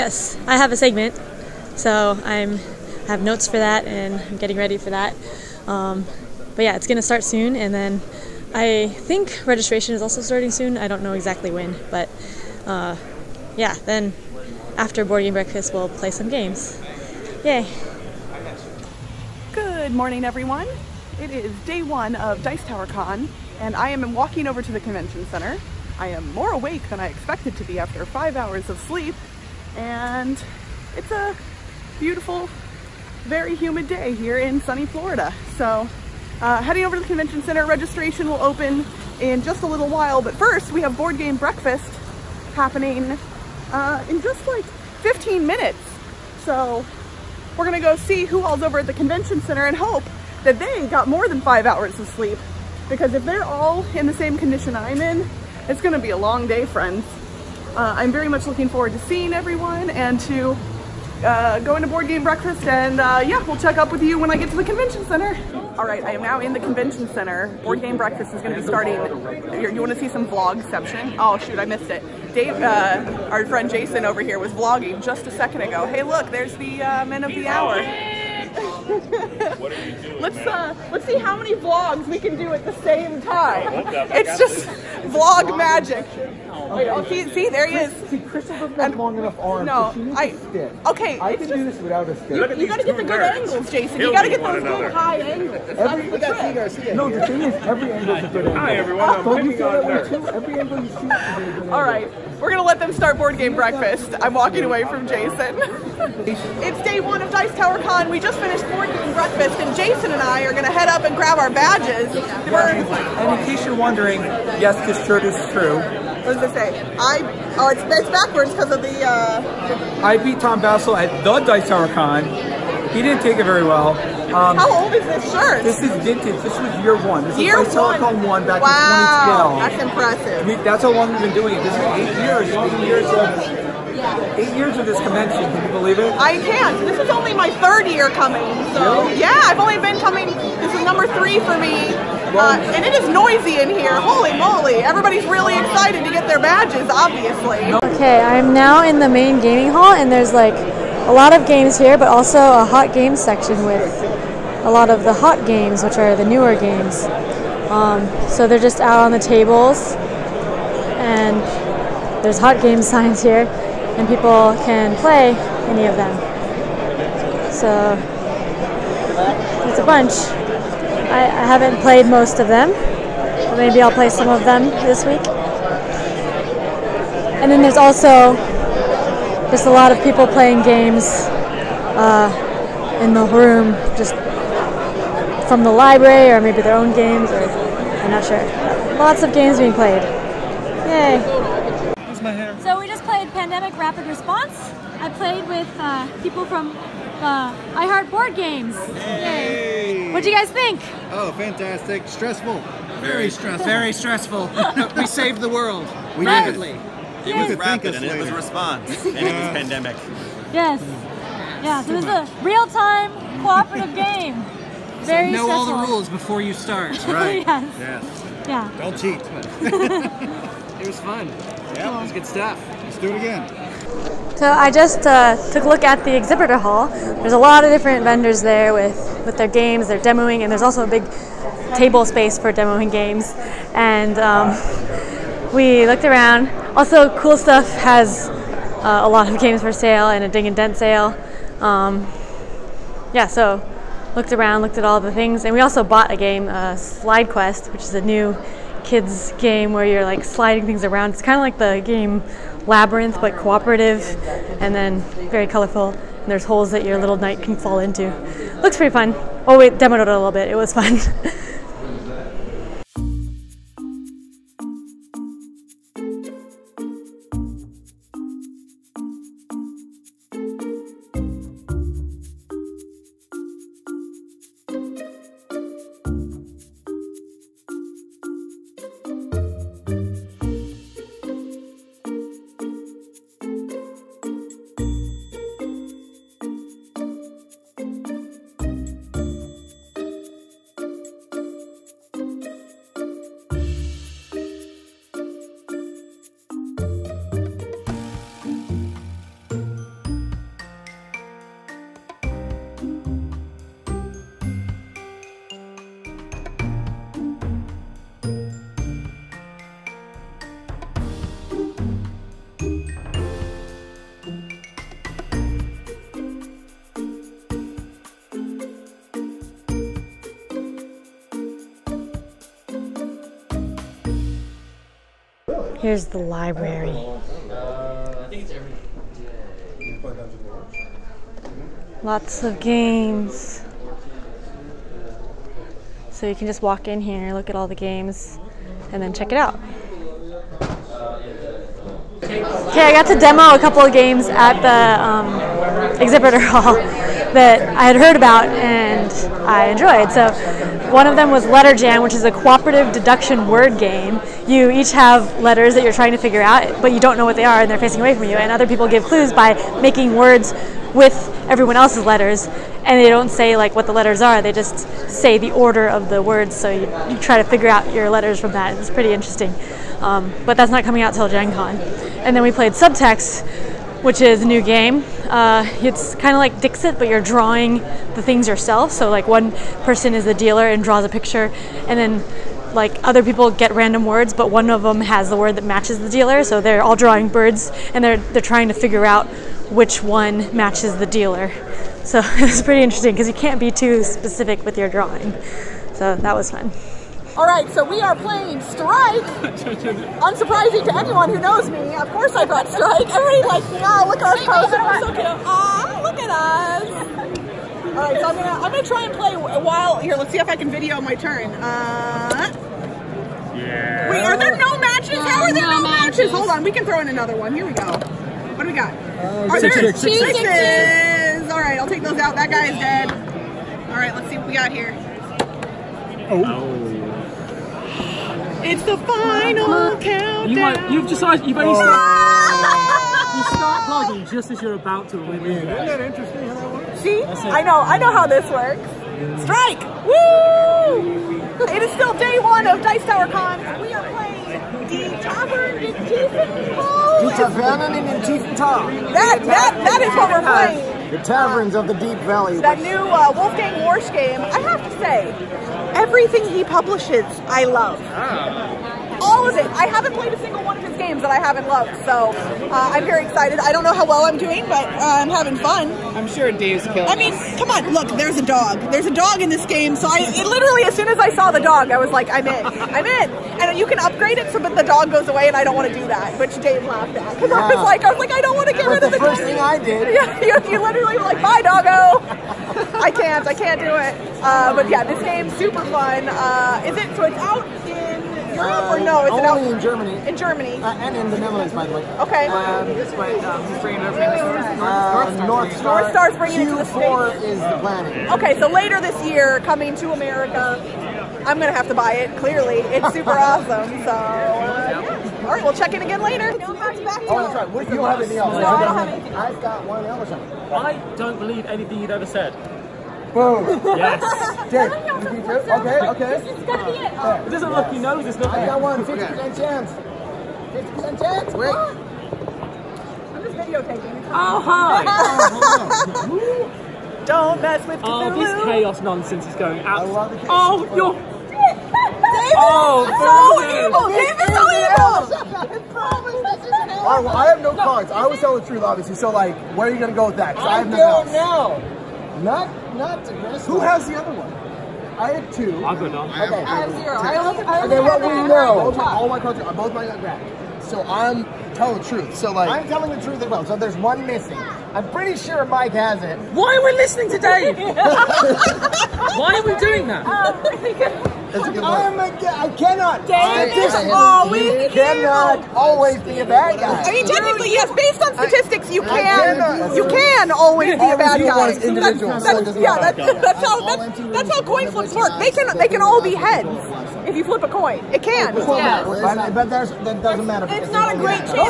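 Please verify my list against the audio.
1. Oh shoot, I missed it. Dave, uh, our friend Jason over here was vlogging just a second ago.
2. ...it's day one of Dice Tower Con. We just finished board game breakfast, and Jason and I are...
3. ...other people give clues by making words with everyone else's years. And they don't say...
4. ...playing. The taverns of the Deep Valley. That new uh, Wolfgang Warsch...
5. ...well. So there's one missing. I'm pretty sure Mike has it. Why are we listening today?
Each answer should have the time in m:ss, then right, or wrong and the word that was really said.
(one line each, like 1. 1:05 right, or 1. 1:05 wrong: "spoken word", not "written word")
1. 1:11 right
2. 1:46 right
3. 5:58 wrong: "letters", not "years"
4. 7:30 right
5. 9:13 right.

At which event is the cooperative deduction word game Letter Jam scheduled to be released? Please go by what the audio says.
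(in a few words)
Gen Con.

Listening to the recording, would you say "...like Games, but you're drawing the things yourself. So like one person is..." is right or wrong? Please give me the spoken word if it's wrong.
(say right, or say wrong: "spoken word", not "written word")
wrong: "Dixit", not "Games".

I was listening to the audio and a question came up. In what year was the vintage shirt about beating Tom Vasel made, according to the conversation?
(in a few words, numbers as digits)
2012.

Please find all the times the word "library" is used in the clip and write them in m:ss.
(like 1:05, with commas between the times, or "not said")
3:05, 5:26.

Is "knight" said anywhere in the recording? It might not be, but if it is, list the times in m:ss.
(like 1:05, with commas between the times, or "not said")
4:17.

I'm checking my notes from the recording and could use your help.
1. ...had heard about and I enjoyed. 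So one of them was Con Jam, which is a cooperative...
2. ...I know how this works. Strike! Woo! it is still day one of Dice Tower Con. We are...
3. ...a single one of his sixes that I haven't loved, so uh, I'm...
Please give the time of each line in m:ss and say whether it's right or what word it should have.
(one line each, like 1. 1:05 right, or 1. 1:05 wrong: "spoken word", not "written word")
1. 5:47 wrong: "Letter", not "Con"
2. 7:17 right
3. 7:40 wrong: "games", not "sixes".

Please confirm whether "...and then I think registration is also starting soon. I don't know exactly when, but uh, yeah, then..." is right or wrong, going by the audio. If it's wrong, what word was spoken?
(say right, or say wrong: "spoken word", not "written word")
right.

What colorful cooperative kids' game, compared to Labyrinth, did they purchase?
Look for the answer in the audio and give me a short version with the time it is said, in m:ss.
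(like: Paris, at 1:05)
Slide Quest, at 4:06.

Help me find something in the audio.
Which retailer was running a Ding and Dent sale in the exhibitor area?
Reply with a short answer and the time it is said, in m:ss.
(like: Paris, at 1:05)
Cool Stuff, at 3:57.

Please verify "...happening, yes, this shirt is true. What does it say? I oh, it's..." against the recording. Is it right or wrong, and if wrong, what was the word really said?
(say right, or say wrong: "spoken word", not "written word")
wrong: "wondering", not "happening".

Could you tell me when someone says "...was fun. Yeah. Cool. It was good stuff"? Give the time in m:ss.
3:40.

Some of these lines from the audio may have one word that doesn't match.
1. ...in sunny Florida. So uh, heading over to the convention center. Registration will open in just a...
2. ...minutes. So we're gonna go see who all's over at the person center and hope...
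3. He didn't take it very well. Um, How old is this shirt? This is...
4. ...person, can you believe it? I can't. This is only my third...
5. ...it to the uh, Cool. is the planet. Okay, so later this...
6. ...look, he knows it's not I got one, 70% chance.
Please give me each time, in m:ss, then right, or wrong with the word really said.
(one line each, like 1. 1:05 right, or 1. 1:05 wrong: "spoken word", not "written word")
1. 0:34 right
2. 0:45 wrong: "convention", not "person"
3. 2:02 right
4. 2:14 wrong: "convention", not "person"
5. 8:16 wrong: "States", not "Cool"
6. 8:37 wrong: "50", not "70".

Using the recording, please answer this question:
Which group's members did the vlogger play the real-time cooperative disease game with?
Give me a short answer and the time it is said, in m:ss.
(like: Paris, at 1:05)
I Heart Board Games, at 3:17.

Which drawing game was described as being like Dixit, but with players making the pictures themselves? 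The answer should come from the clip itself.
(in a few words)
Subtext.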